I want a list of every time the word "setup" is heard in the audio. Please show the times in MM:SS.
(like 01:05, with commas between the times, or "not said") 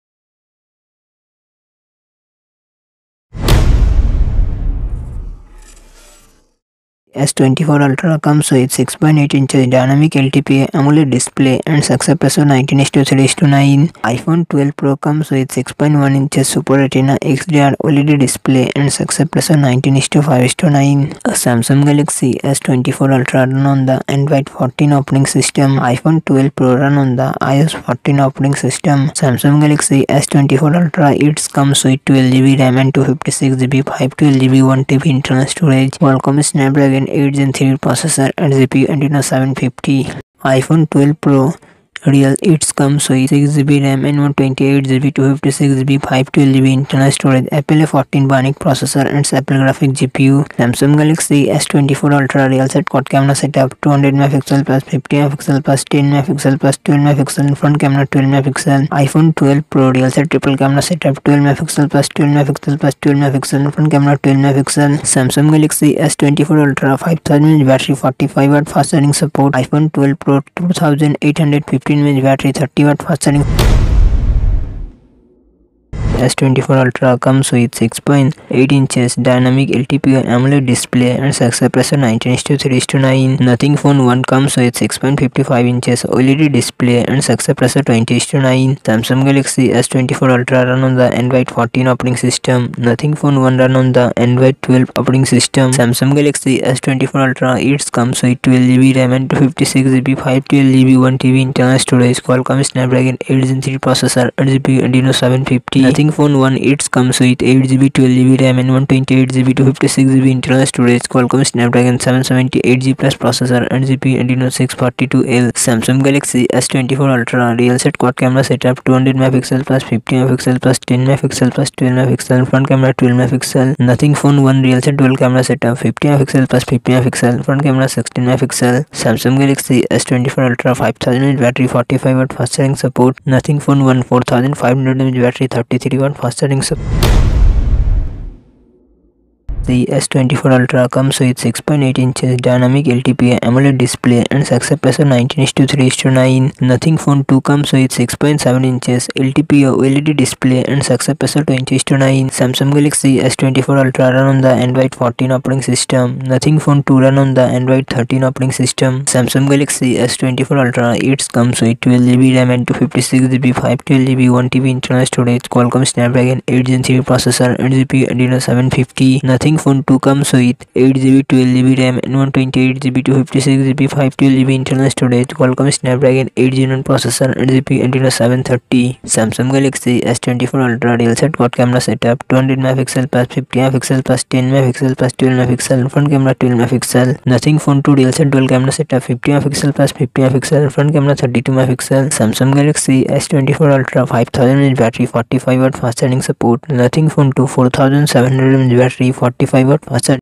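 00:53, 01:00, 01:58, 02:05, 03:01, 03:08.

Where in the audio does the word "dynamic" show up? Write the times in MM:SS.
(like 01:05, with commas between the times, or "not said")
00:09, 01:19, 02:22.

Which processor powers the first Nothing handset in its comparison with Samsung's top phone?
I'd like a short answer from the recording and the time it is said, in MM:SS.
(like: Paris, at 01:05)
Snapdragon 778G Plus, at 01:51.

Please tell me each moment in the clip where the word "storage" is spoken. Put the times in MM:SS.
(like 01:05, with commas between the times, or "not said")
00:35, 00:47, 01:41, 01:50, 02:45, 02:54.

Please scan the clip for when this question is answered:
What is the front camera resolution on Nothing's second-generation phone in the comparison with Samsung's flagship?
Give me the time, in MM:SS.
03:11.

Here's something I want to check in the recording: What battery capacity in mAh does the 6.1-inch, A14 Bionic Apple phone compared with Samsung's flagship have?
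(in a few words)
2850.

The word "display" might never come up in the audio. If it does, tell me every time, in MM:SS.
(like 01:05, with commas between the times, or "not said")
00:11, 00:18, 01:20, 01:26, 02:23, 02:30.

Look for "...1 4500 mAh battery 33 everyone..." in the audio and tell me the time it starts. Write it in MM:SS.
02:13.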